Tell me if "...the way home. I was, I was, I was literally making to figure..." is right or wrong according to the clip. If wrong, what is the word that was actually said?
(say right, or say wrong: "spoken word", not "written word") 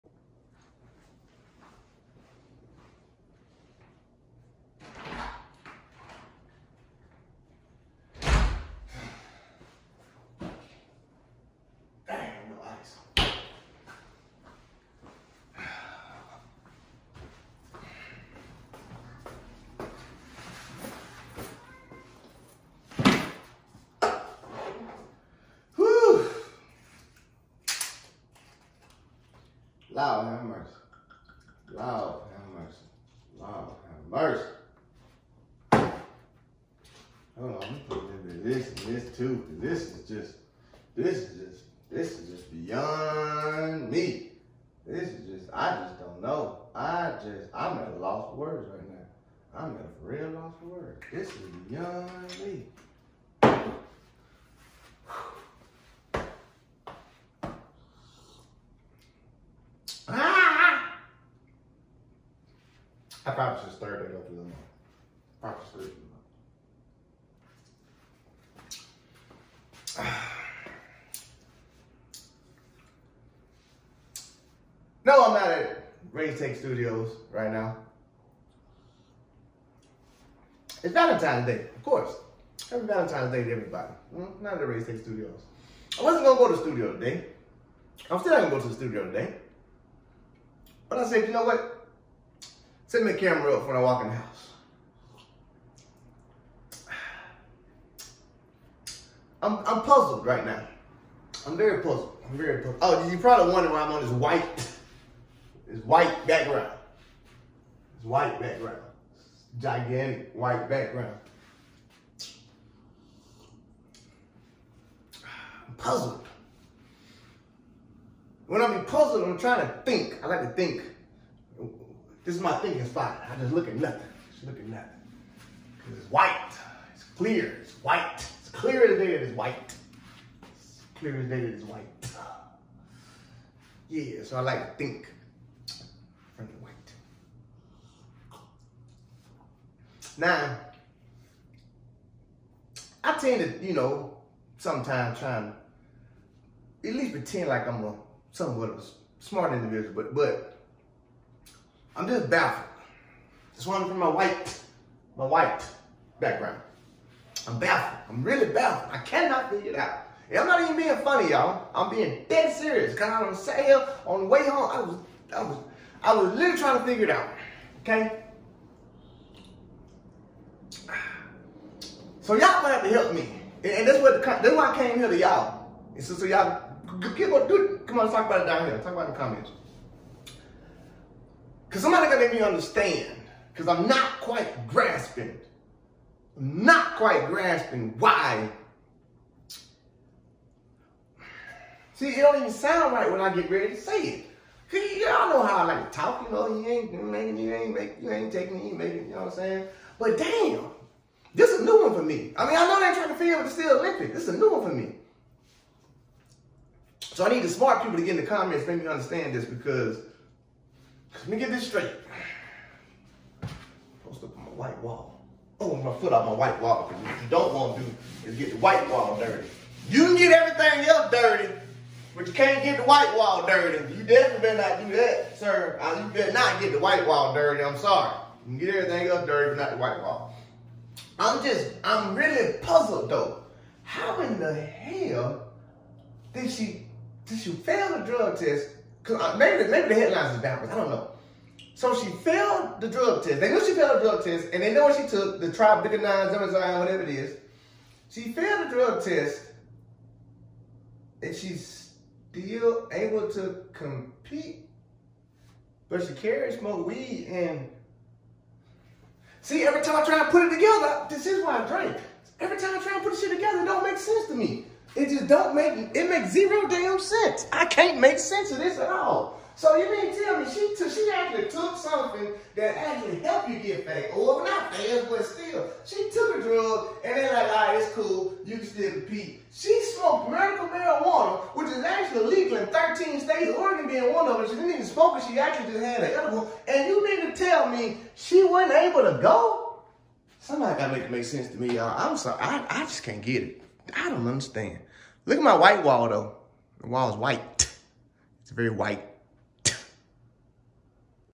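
wrong: "trying", not "making".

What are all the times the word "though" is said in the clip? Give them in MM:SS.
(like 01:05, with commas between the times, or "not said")
03:53, 04:56.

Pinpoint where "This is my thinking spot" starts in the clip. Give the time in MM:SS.
02:02.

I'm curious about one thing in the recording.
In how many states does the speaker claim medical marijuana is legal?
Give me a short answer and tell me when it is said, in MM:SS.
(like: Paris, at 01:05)
13, at 04:42.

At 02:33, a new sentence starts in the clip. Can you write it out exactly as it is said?
That's why I'm from my white, my white background.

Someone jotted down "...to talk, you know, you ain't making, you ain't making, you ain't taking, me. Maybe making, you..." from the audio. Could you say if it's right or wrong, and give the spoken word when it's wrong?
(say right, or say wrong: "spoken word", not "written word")
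right.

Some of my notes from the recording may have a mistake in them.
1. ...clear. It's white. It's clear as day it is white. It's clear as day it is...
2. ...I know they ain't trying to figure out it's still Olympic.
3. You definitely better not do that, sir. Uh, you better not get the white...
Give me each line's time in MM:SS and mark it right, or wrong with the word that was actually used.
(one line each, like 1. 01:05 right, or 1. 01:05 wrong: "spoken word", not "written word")
1. 02:07 right
2. 03:22 right
3. 03:43 right.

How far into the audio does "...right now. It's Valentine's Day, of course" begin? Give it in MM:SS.
01:17.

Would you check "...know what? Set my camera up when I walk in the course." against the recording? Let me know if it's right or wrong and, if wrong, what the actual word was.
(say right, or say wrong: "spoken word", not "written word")
wrong: "house", not "course".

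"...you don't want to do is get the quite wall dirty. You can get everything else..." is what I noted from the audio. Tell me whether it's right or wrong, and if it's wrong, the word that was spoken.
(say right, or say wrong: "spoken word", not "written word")
wrong: "white", not "quite".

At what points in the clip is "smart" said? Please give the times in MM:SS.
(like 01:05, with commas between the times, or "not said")
02:29, 03:27.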